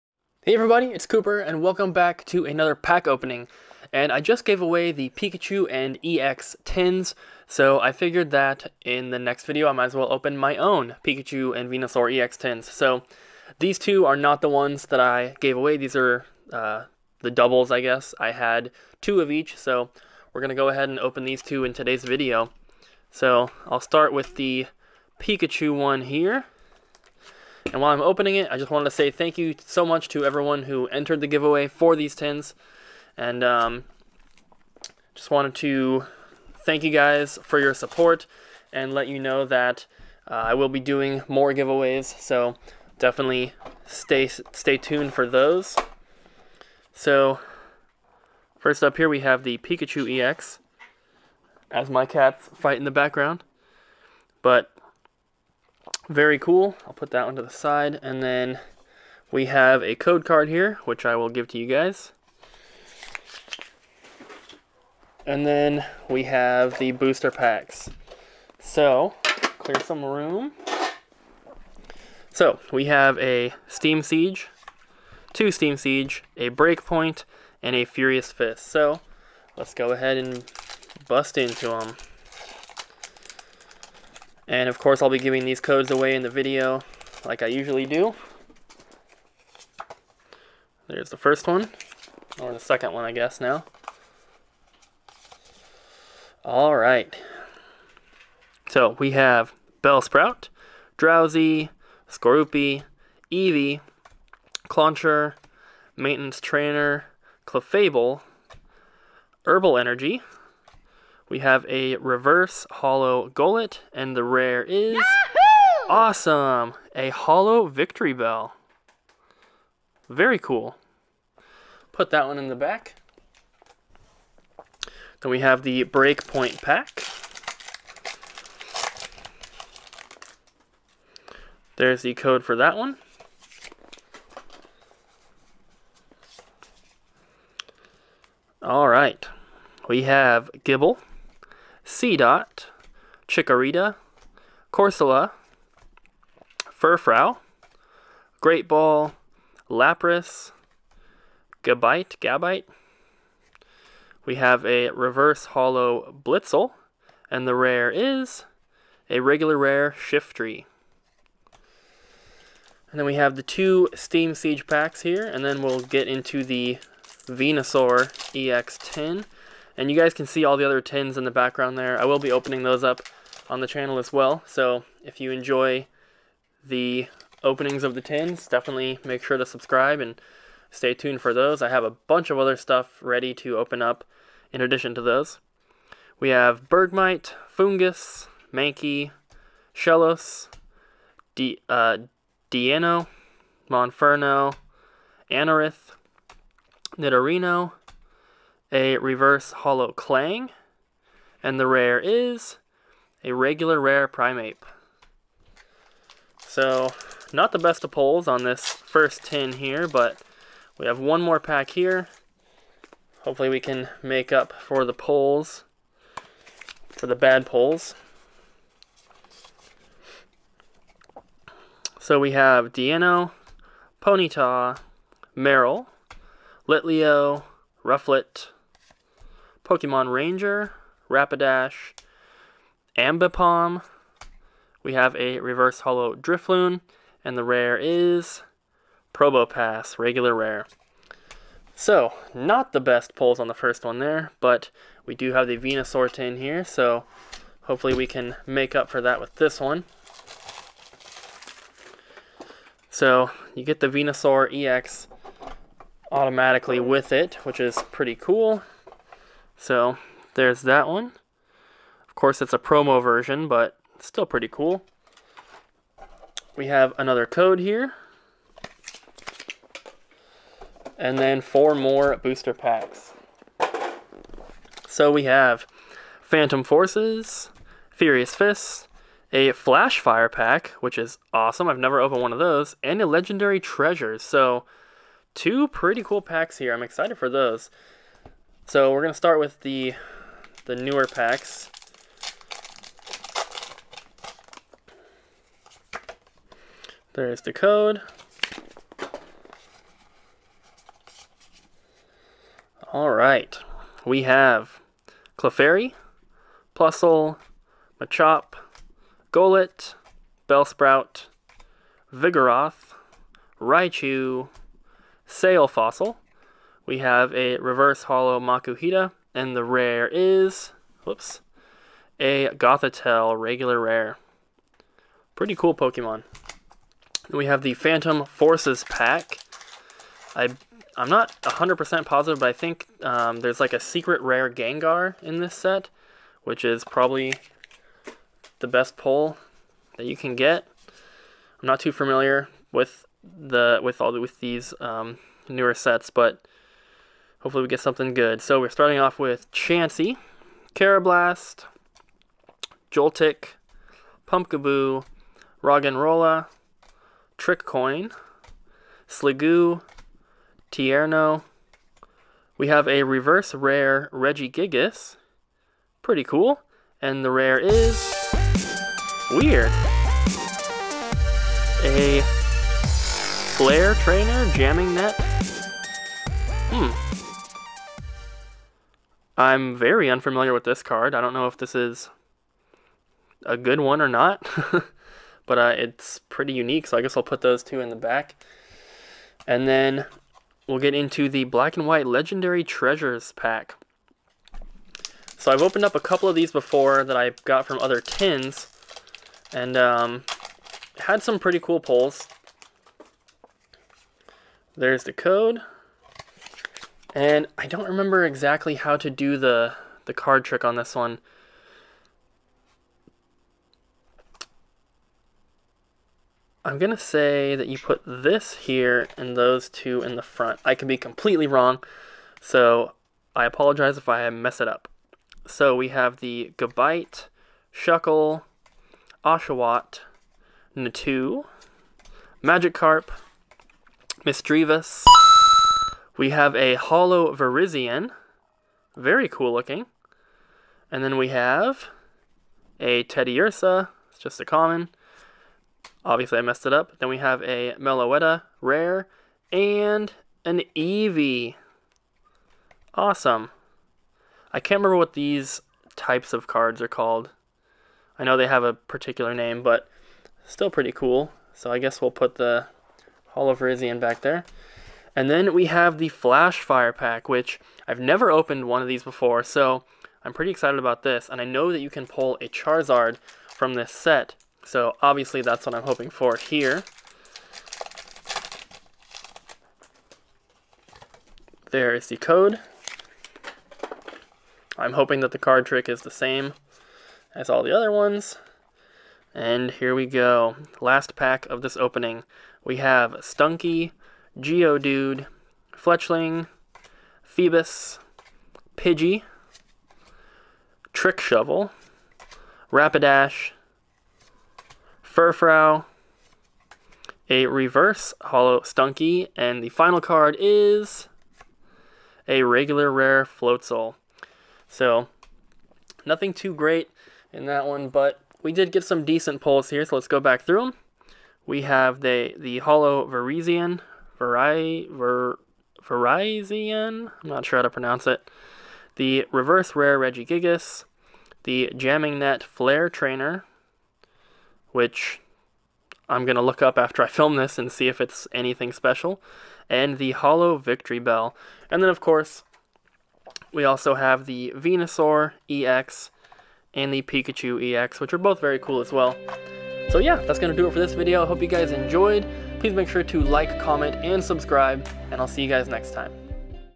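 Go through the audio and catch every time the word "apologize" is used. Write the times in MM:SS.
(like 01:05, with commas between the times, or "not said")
07:03.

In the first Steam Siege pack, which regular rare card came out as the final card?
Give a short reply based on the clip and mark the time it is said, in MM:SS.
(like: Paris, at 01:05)
Primeape, at 03:23.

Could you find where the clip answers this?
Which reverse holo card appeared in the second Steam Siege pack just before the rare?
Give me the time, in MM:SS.
03:55.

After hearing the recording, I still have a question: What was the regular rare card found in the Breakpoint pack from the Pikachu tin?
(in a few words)
Shiftry.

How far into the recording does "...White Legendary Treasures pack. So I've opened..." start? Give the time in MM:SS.
06:31.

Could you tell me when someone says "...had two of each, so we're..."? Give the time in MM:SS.
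00:18.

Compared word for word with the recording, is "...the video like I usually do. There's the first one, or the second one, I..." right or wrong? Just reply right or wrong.
right.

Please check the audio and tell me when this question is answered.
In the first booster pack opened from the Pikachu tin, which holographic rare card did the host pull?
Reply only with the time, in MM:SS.
01:56.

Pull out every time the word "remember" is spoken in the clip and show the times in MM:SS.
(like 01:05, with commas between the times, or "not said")
06:47, 07:34.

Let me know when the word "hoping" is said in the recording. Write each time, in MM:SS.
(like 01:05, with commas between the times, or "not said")
07:55, 08:04.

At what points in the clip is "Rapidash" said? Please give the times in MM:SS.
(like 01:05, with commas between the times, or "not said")
03:51, 08:22.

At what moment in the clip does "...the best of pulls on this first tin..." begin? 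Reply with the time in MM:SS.
03:27.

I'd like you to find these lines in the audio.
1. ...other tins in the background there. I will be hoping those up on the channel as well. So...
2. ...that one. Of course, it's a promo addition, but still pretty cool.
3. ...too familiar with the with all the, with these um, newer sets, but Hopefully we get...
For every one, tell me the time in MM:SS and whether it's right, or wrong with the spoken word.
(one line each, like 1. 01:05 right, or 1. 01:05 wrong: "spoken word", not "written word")
1. 02:50 wrong: "opening", not "hoping"
2. 04:20 wrong: "version", not "addition"
3. 05:41 right.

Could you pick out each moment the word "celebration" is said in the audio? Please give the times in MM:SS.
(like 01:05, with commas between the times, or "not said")
not said.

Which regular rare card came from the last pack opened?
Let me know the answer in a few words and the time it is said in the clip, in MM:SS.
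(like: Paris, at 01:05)
Floatzel, at 08:32.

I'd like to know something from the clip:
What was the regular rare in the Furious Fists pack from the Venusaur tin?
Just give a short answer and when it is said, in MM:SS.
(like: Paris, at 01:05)
Gothitelle, at 05:22.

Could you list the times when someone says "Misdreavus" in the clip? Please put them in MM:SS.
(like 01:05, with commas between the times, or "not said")
07:14.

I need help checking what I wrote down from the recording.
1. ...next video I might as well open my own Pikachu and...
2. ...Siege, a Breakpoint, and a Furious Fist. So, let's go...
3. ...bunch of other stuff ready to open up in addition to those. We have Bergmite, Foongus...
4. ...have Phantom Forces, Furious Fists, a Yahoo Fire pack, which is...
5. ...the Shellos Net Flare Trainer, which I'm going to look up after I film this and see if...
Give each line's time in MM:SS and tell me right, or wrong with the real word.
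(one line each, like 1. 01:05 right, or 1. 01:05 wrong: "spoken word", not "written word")
1. 00:09 right
2. 01:15 right
3. 03:01 right
4. 04:35 wrong: "Flash", not "Yahoo"
5. 08:51 wrong: "Jamming", not "Shellos".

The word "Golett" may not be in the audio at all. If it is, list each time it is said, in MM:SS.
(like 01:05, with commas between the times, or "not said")
01:53, 05:09.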